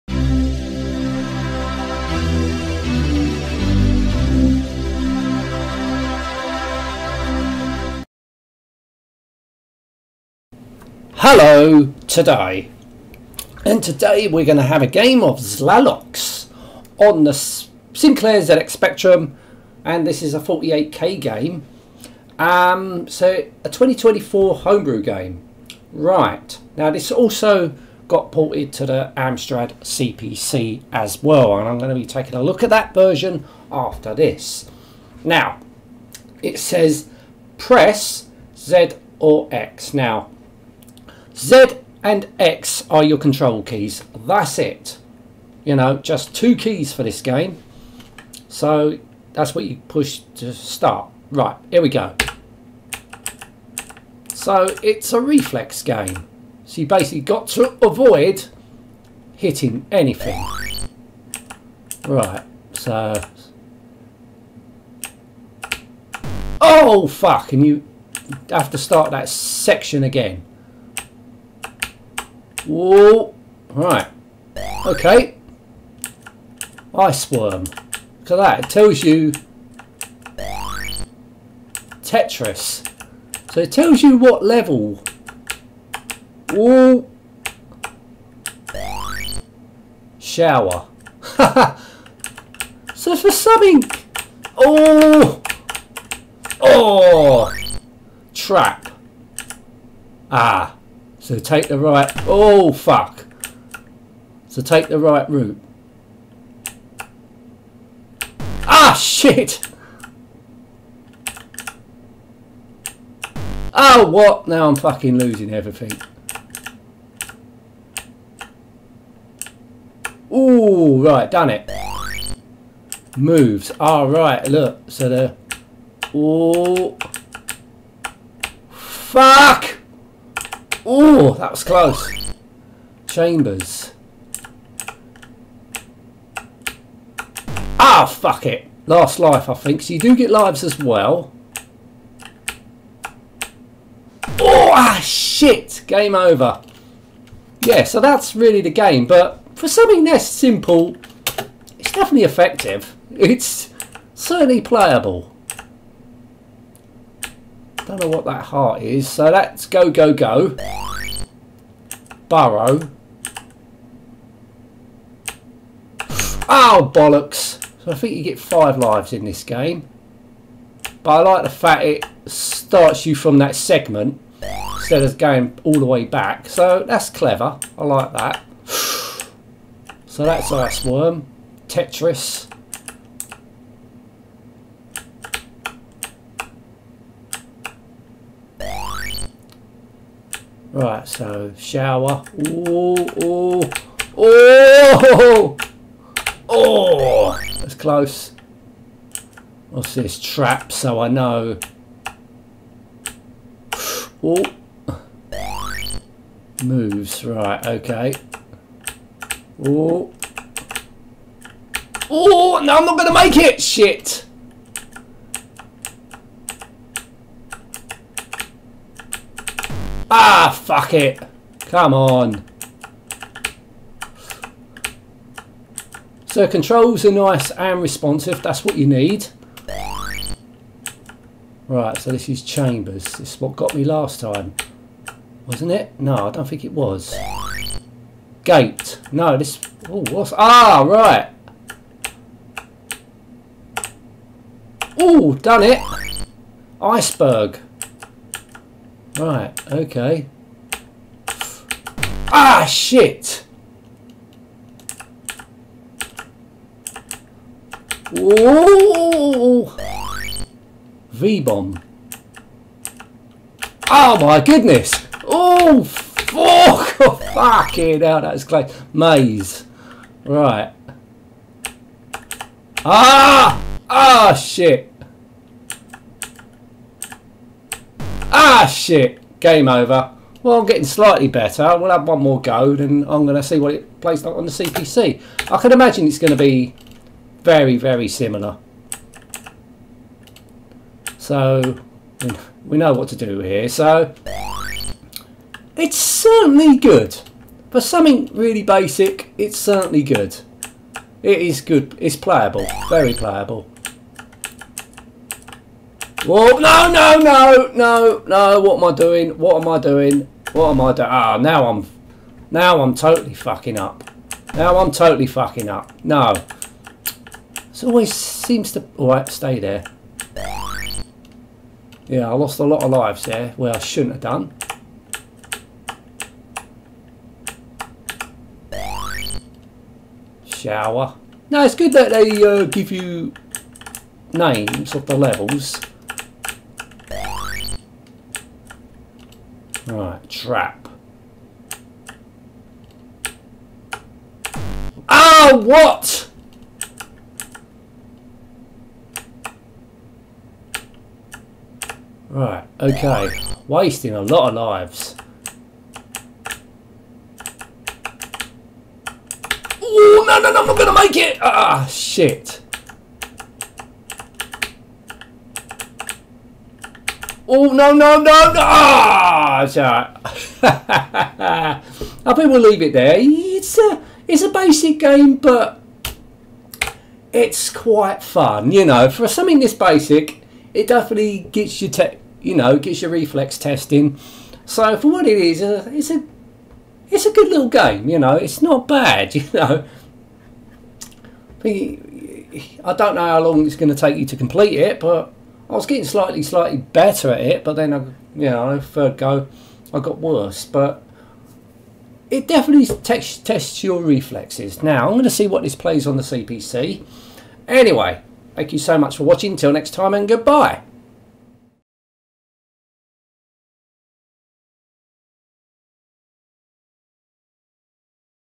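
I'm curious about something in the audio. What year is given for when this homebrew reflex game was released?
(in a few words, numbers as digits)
2024.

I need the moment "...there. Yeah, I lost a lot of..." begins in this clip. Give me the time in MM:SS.
05:19.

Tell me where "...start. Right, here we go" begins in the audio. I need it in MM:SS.
00:50.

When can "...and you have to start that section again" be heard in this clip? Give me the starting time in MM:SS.
01:07.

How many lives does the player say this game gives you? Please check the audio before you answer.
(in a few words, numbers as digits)
5.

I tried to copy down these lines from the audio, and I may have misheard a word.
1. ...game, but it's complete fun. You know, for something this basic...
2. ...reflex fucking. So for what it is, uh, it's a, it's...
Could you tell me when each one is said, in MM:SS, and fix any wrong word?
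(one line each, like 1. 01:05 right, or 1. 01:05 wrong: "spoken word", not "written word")
1. 06:14 wrong: "quite", not "complete"
2. 06:23 wrong: "testing", not "fucking".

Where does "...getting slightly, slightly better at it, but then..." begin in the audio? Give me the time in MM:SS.
06:35.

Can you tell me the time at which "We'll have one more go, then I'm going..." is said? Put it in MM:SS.
04:41.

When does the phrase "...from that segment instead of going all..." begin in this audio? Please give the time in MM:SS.
02:53.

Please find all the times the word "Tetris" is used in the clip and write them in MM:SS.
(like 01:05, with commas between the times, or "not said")
01:22, 03:01.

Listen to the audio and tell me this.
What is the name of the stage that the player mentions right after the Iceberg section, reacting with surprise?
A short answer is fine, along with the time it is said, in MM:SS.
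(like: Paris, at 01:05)
V-bomb, at 04:21.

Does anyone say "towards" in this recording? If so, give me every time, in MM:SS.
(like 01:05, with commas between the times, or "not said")
not said.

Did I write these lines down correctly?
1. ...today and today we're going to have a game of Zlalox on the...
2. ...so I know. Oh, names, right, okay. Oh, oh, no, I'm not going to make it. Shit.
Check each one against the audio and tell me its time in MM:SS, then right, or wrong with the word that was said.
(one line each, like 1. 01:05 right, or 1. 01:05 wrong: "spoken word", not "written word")
1. 00:12 right
2. 03:20 wrong: "moves", not "names".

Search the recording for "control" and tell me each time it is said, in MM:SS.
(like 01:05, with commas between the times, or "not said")
00:43, 03:46.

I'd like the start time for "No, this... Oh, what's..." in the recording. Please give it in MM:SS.
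03:59.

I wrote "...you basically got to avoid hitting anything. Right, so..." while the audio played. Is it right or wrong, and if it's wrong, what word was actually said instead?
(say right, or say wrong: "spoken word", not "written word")
right.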